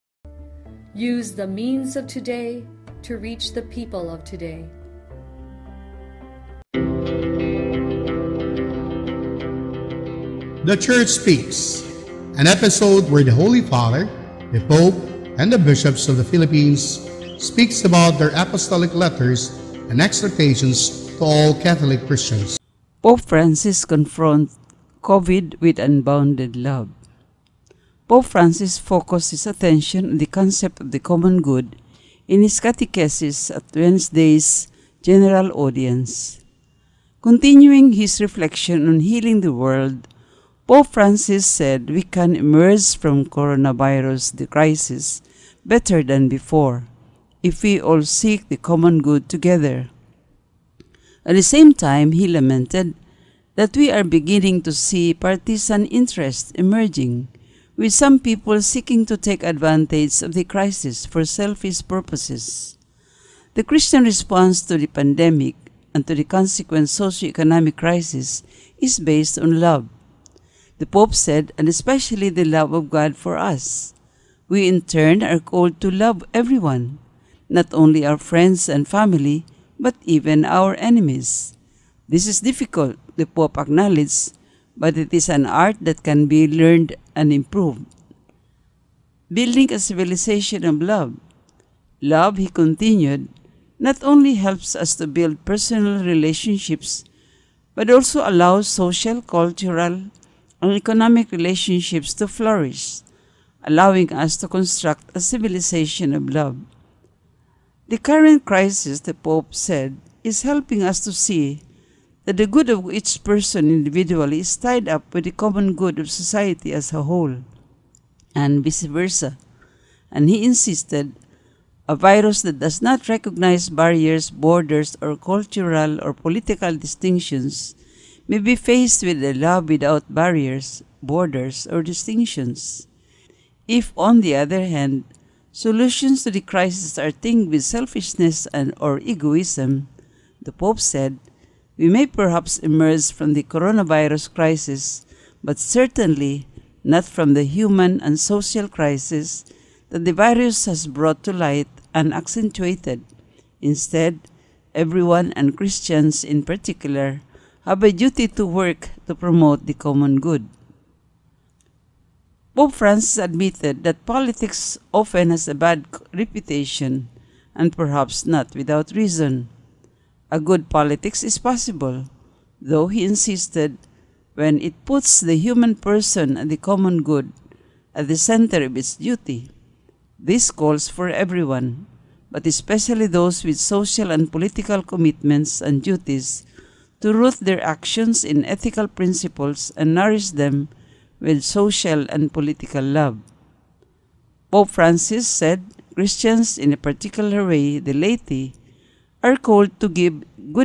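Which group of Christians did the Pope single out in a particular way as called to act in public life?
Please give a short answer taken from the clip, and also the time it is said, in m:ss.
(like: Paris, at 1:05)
The laity, at 3:17.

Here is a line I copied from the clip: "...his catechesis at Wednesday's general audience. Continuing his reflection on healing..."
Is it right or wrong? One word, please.
right.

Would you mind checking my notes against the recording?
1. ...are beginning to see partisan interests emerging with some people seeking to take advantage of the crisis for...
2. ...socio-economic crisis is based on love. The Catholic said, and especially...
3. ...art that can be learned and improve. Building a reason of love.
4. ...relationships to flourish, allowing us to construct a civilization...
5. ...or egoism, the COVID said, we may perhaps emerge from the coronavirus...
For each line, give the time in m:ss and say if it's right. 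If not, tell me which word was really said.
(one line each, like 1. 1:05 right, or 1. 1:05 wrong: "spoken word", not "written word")
1. 0:53 right
2. 1:06 wrong: "Pope", not "Catholic"
3. 1:25 wrong: "civilization", not "reason"
4. 1:41 right
5. 2:18 wrong: "Pope", not "COVID".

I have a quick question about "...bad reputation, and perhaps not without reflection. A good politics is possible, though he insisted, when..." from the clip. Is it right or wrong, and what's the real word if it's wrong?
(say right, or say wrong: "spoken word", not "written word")
wrong: "reason", not "reflection".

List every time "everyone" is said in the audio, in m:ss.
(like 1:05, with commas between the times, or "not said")
1:16, 2:34, 3:01.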